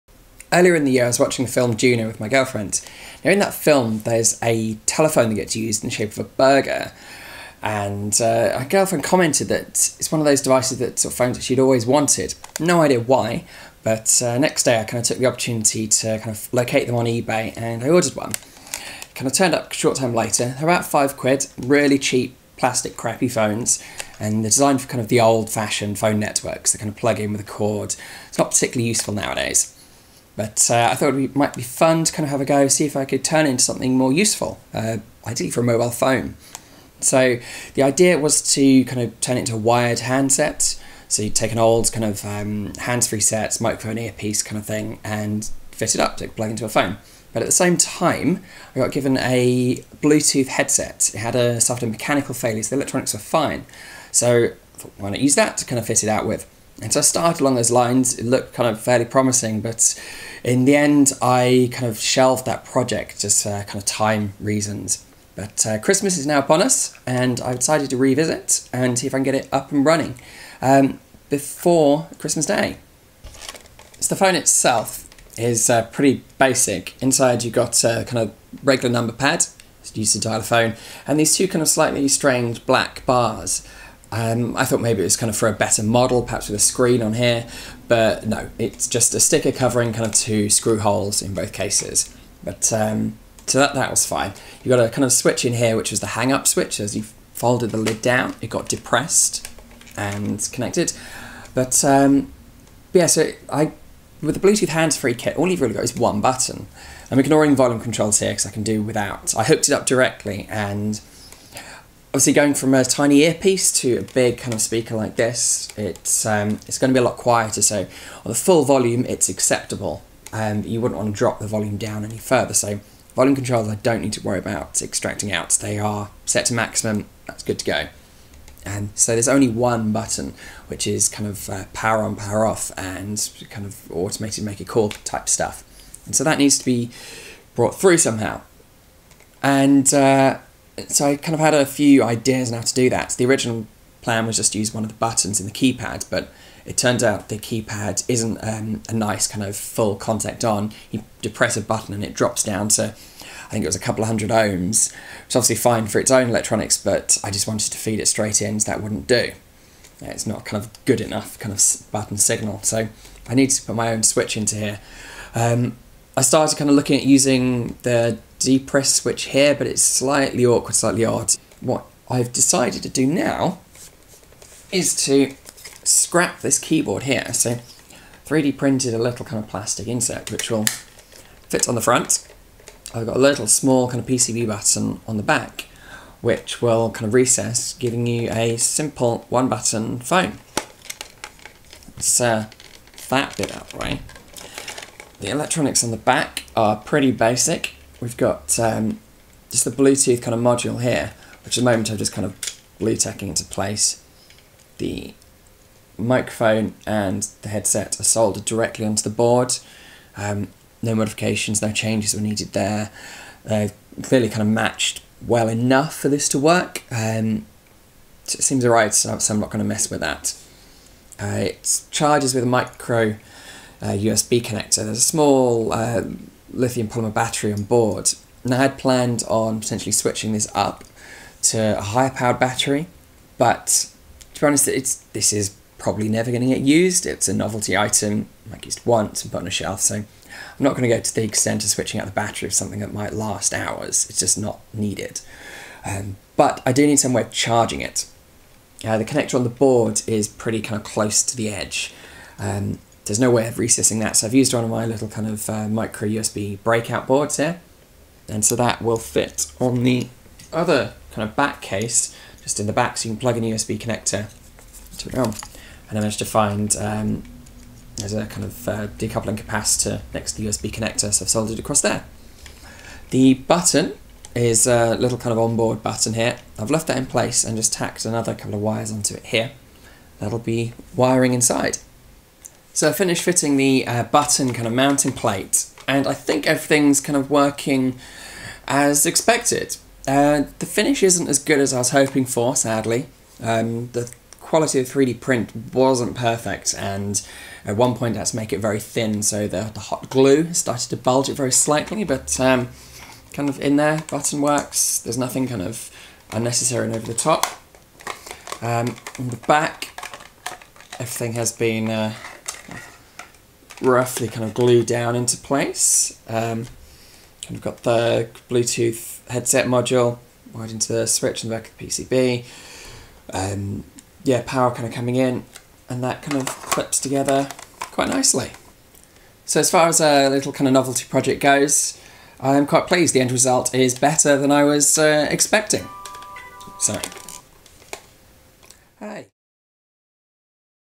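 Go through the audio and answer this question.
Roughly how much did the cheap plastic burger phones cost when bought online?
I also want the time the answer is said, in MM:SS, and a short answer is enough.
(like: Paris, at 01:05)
5 quid, at 00:20.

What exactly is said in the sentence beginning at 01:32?
But um, so that, that was fine.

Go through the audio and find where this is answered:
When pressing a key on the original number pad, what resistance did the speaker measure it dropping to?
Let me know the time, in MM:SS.
02:33.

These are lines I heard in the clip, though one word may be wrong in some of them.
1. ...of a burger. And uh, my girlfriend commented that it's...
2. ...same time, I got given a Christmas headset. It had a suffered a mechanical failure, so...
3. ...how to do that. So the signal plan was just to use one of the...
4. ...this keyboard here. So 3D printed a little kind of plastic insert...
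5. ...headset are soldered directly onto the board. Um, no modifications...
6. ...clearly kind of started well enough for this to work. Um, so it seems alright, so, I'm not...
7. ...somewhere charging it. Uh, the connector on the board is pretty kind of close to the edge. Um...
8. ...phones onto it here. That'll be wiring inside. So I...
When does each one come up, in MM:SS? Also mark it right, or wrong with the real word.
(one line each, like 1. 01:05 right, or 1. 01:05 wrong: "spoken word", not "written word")
1. 00:06 right
2. 00:47 wrong: "Bluetooth", not "Christmas"
3. 02:22 wrong: "original", not "signal"
4. 02:56 right
5. 03:27 right
6. 03:34 wrong: "matched", not "started"
7. 04:06 right
8. 04:38 wrong: "wires", not "phones".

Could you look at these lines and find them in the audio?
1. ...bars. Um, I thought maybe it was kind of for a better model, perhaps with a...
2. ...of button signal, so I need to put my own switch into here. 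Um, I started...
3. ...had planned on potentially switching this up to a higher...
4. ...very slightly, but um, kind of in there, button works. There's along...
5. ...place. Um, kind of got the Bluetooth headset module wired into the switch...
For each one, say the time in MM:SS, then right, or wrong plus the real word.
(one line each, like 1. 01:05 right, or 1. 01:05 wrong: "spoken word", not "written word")
1. 01:23 right
2. 02:41 right
3. 03:48 right
4. 05:01 wrong: "nothing", not "along"
5. 05:15 right.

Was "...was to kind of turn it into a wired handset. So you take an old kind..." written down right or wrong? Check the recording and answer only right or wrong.
right.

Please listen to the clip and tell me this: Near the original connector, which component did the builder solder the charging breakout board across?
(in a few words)
Decoupling capacitor.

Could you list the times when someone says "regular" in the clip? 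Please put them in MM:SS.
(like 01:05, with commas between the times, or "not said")
01:18.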